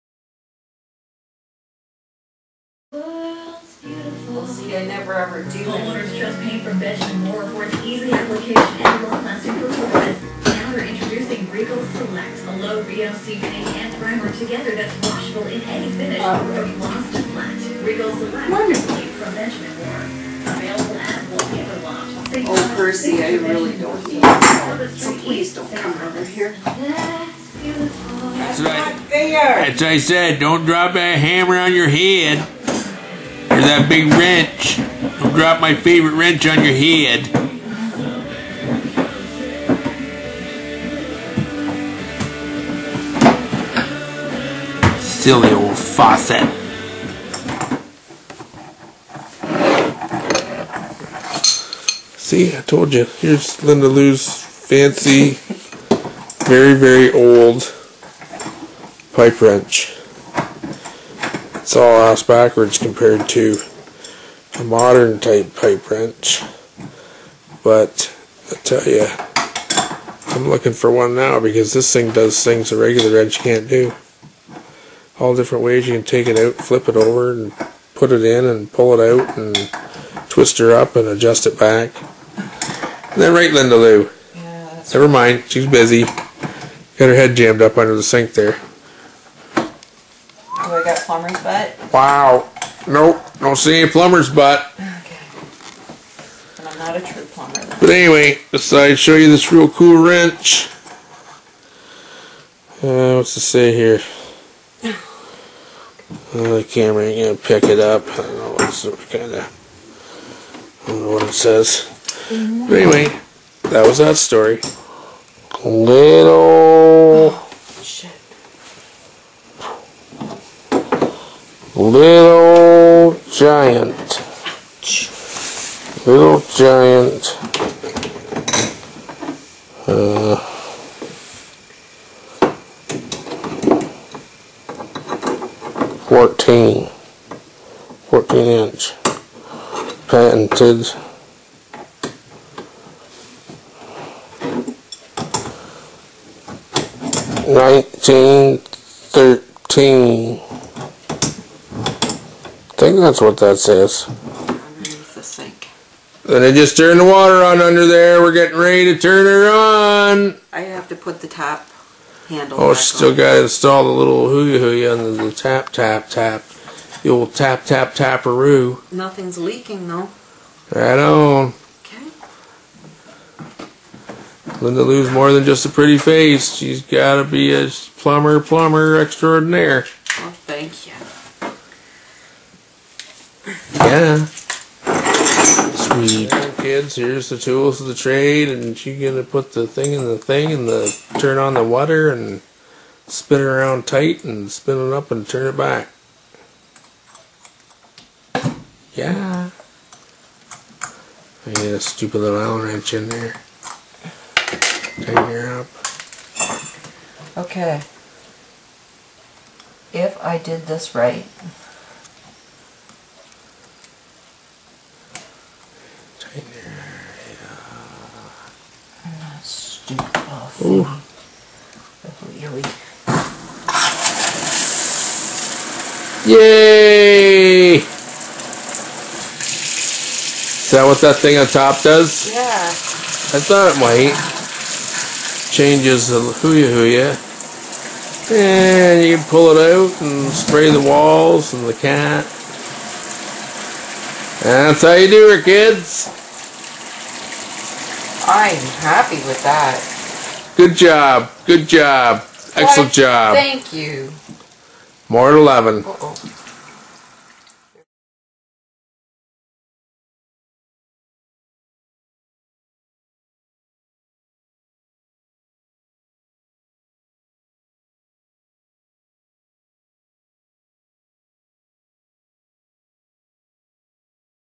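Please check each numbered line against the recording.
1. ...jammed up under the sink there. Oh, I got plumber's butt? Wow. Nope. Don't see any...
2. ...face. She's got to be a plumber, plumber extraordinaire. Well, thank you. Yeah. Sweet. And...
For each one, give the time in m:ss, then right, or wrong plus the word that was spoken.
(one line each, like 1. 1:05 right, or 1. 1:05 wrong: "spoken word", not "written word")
1. 1:27 right
2. 2:55 right.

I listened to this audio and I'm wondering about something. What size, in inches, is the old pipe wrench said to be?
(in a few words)
14.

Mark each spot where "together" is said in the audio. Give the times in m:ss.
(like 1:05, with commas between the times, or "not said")
0:14.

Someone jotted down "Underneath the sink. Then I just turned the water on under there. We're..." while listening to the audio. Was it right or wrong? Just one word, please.
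right.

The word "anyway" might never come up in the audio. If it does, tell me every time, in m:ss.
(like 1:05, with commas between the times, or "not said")
1:37, 1:52.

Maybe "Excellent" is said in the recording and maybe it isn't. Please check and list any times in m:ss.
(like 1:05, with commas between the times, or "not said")
4:12.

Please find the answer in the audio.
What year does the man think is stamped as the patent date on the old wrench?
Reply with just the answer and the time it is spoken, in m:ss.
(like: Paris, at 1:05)
1913, at 2:27.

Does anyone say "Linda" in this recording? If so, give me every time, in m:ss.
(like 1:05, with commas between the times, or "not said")
0:53, 1:23, 2:54.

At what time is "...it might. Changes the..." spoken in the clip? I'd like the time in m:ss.
3:53.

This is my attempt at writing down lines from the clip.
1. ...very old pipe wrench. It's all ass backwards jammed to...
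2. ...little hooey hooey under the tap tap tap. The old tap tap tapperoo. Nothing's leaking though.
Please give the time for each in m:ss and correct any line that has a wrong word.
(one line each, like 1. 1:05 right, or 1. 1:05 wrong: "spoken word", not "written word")
1. 0:56 wrong: "compared", not "jammed"
2. 2:43 right.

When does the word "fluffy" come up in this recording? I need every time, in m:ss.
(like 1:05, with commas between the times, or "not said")
not said.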